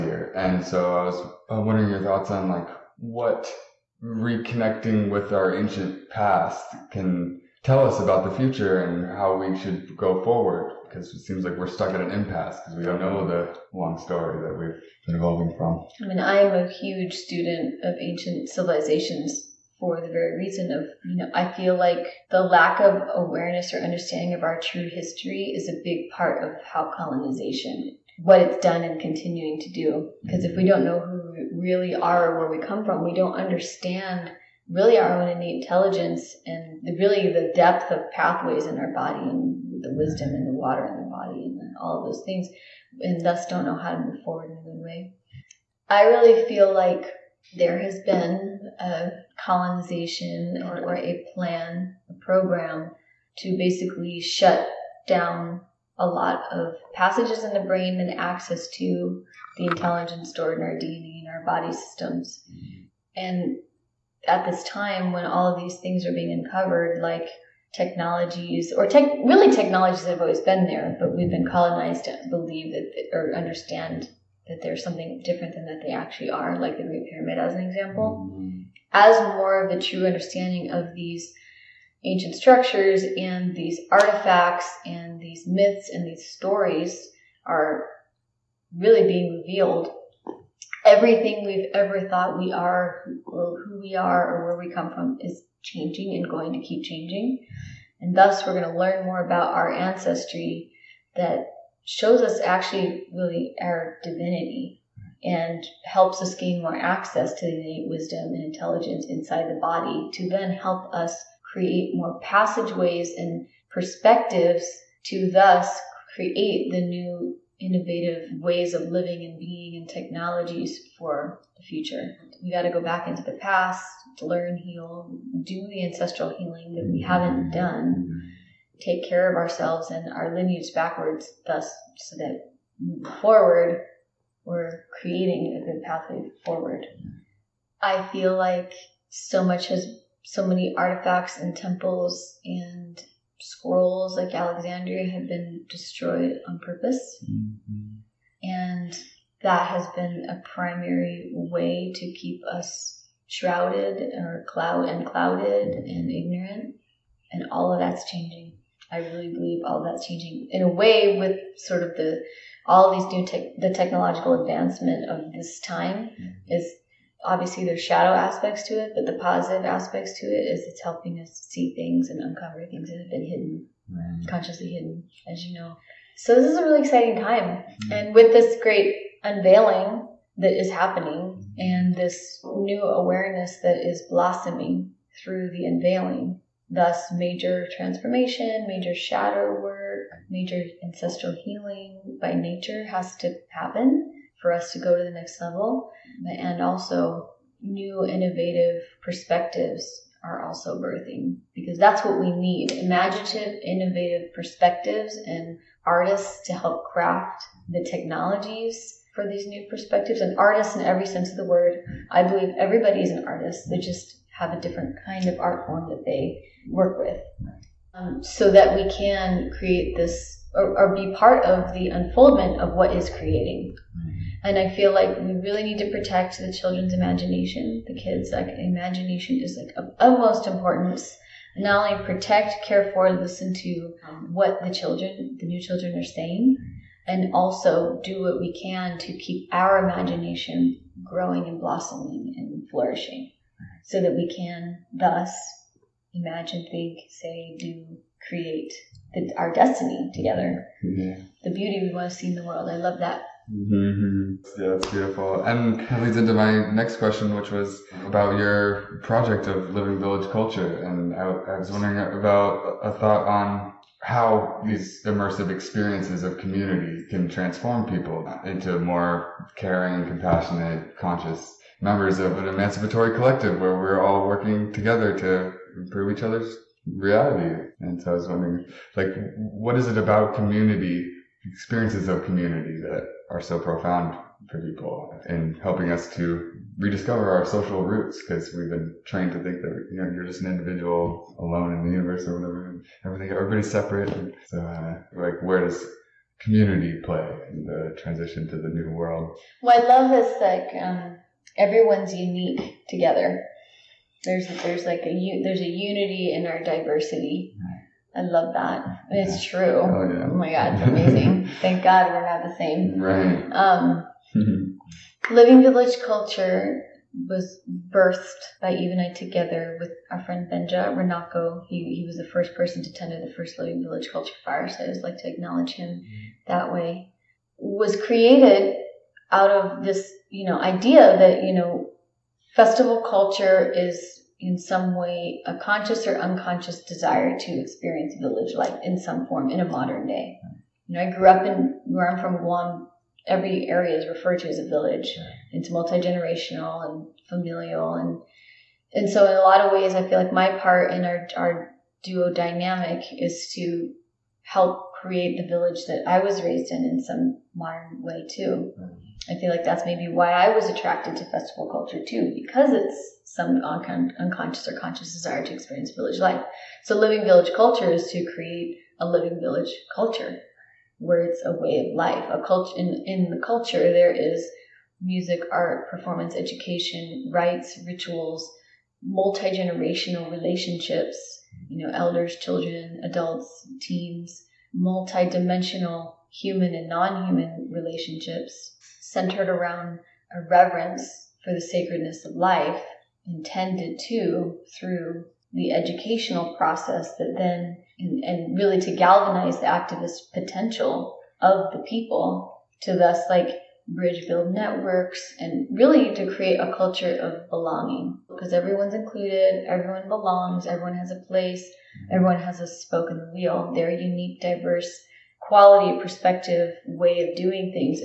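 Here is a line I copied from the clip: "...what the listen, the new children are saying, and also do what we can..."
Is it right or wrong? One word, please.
wrong.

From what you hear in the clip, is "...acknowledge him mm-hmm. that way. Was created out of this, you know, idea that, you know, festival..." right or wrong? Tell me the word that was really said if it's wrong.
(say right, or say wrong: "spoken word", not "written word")
right.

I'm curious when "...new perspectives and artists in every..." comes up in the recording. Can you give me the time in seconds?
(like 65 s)
209 s.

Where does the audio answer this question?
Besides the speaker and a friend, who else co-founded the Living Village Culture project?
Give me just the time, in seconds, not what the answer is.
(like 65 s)
318 s.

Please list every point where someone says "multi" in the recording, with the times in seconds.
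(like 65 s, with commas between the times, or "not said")
345 s, 379 s, 384 s.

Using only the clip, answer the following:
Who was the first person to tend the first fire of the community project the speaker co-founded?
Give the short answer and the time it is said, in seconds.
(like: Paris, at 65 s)
Benja Renako, at 320 s.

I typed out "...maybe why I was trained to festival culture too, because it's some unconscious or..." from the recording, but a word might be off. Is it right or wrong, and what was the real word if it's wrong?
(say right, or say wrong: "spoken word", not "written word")
wrong: "attracted", not "trained".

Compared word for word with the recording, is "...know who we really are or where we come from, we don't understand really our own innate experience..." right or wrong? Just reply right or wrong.
wrong.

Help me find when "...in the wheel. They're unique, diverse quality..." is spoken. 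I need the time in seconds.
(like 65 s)
413 s.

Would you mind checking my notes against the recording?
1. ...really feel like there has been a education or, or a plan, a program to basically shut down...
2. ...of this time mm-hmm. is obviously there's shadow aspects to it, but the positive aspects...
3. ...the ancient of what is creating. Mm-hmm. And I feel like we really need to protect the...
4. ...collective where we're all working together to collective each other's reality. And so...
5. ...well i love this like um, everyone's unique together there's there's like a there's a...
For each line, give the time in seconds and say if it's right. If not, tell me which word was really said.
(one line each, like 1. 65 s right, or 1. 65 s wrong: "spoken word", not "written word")
1. 46 s wrong: "colonization", not "education"
2. 165 s right
3. 221 s wrong: "unfoldment", not "ancient"
4. 273 s wrong: "improve", not "collective"
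5. 299 s right.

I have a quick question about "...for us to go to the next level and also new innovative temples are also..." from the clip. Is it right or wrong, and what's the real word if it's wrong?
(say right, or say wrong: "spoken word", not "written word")
wrong: "perspectives", not "temples".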